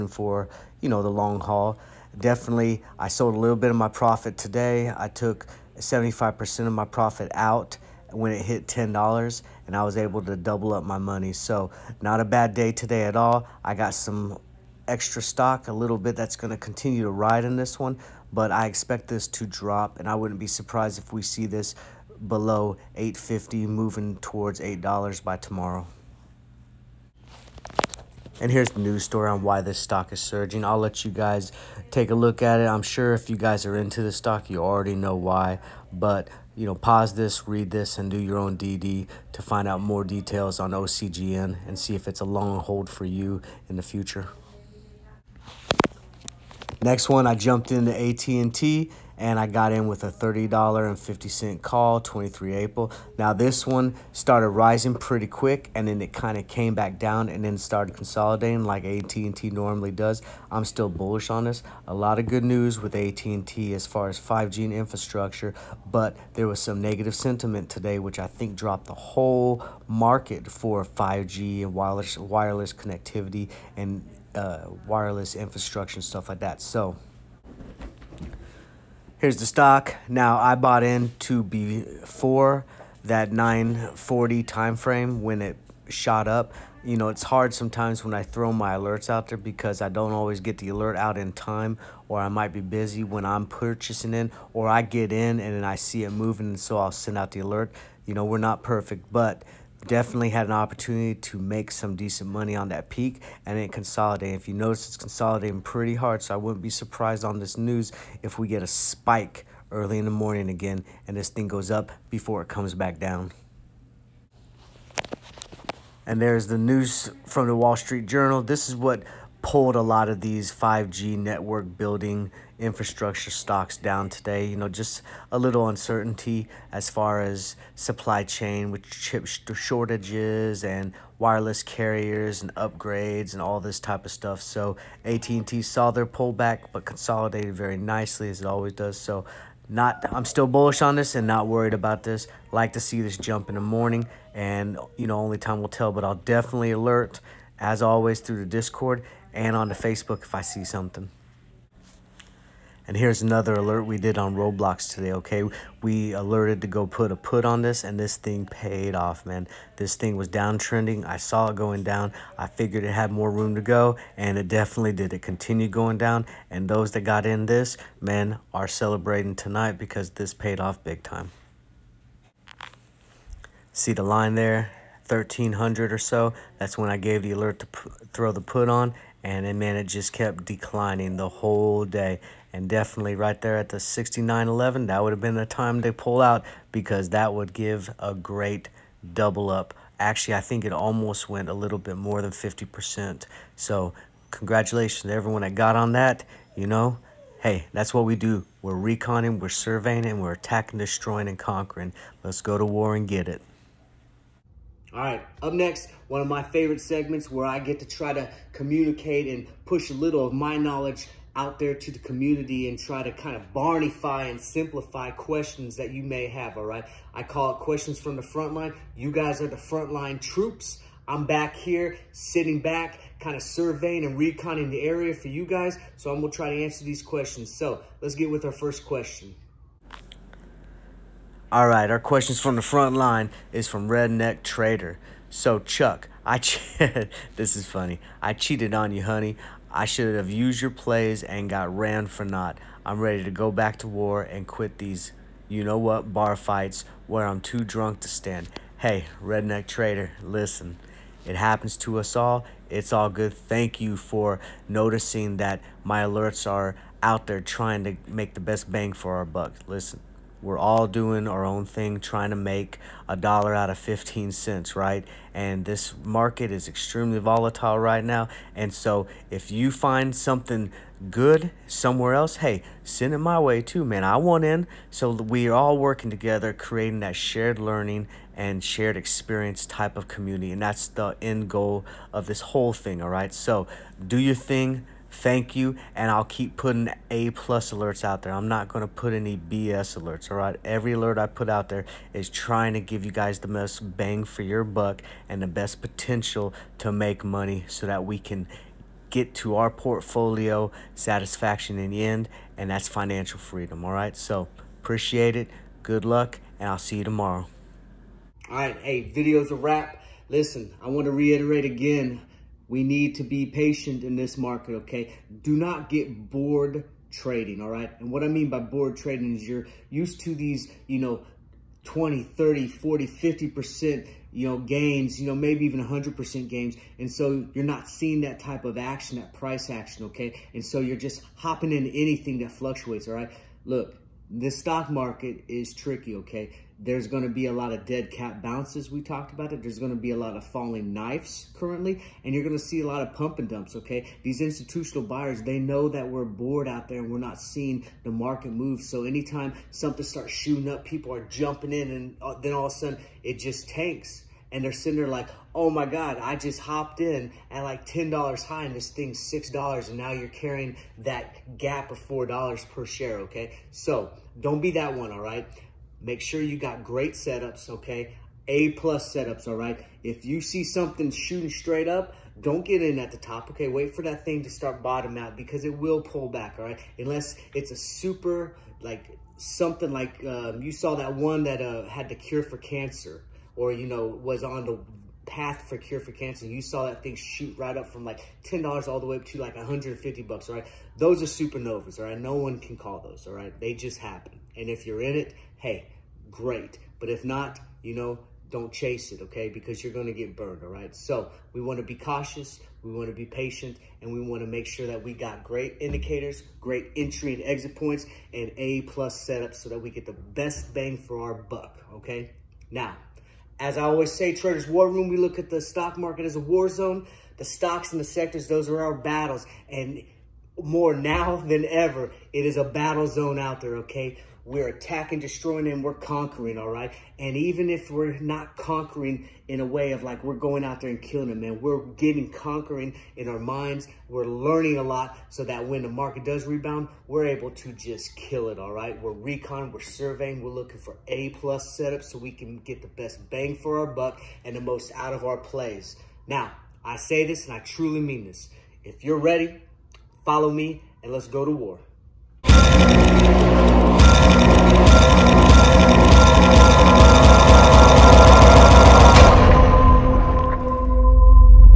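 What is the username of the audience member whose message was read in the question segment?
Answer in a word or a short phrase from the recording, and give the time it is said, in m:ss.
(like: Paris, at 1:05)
Redneck Trader, at 3:53.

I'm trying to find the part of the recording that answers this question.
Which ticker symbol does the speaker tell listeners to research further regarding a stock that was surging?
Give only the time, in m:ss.
0:40.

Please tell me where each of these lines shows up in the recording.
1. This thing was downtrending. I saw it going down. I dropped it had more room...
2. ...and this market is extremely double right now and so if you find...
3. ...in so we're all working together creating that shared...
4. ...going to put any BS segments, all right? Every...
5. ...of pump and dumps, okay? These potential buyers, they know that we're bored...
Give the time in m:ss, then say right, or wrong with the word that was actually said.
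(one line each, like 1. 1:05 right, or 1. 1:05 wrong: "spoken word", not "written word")
1. 2:39 wrong: "figured", not "dropped"
2. 4:25 wrong: "volatile", not "double"
3. 4:34 right
4. 4:48 wrong: "alerts", not "segments"
5. 5:43 wrong: "institutional", not "potential".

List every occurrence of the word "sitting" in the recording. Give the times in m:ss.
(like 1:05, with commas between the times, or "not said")
3:42, 5:54.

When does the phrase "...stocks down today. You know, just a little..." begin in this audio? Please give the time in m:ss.
2:03.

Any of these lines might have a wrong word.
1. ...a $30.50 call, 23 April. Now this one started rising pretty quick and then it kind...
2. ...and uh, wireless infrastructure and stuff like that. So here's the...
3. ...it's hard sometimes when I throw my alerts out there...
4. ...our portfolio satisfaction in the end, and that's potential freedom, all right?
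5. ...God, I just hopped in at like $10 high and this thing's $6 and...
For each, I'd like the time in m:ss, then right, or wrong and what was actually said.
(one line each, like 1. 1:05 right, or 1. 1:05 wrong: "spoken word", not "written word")
1. 0:50 right
2. 1:13 right
3. 1:27 right
4. 4:59 wrong: "financial", not "potential"
5. 5:55 right.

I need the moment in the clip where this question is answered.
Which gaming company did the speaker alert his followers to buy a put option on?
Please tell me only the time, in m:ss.
2:34.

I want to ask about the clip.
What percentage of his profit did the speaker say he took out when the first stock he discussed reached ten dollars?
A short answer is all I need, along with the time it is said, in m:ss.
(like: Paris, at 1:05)
75%, at 0:05.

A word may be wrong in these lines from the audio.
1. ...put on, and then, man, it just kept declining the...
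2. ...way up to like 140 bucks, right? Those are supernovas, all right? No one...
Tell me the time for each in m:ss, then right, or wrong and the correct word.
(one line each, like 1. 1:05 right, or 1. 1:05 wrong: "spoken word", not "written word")
1. 2:58 right
2. 6:29 wrong: "150", not "140".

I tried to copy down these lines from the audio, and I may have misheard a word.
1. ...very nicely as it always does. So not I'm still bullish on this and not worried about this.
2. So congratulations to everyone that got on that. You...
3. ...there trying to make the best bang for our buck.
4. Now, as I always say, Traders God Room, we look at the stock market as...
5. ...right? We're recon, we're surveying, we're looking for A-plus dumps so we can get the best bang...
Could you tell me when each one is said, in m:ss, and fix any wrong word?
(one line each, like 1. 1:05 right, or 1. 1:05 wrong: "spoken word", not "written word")
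1. 2:17 right
2. 3:13 right
3. 4:17 right
4. 6:52 wrong: "War", not "God"
5. 7:18 wrong: "setups", not "dumps".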